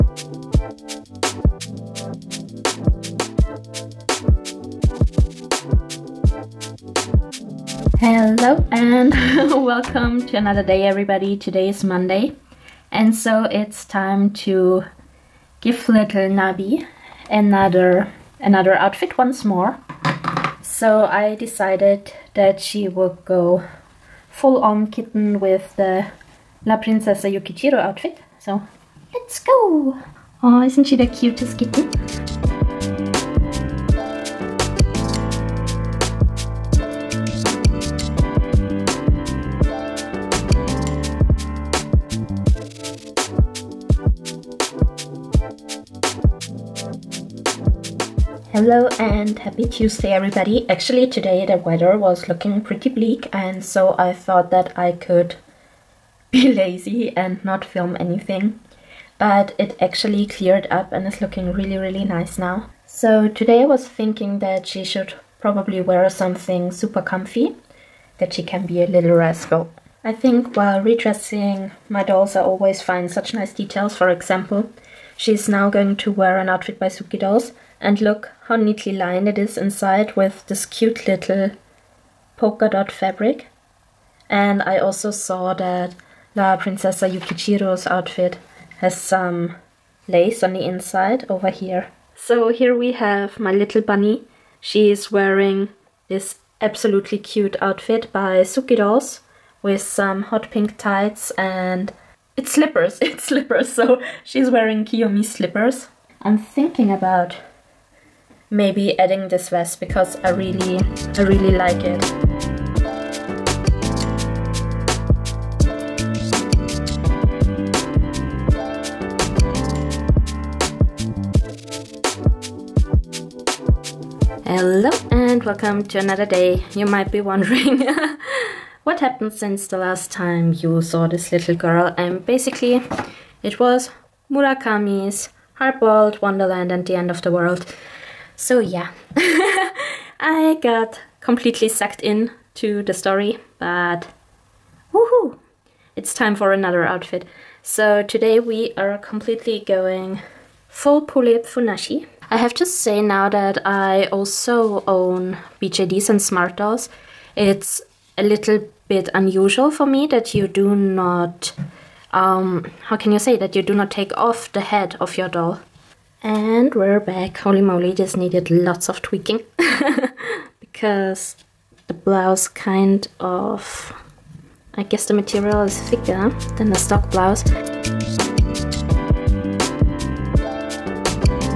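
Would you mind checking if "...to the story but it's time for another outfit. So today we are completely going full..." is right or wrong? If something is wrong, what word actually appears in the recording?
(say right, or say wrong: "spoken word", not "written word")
right.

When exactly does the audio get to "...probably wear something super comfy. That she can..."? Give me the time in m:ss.
1:05.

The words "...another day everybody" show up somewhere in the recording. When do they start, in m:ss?
0:10.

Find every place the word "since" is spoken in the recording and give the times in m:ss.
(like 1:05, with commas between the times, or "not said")
2:09.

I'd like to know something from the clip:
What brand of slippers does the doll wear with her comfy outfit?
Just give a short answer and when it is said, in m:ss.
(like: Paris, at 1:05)
Kiyomi, at 1:44.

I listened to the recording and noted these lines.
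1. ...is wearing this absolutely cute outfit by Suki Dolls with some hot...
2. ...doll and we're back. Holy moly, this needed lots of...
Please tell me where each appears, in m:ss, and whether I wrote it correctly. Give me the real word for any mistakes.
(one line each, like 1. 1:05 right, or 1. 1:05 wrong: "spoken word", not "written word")
1. 1:34 right
2. 2:45 right.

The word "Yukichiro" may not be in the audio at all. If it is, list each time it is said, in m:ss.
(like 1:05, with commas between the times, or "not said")
0:27, 1:27.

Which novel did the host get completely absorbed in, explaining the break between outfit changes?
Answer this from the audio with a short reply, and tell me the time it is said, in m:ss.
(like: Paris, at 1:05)
Hardboiled Wonderland and the End of the World, at 2:15.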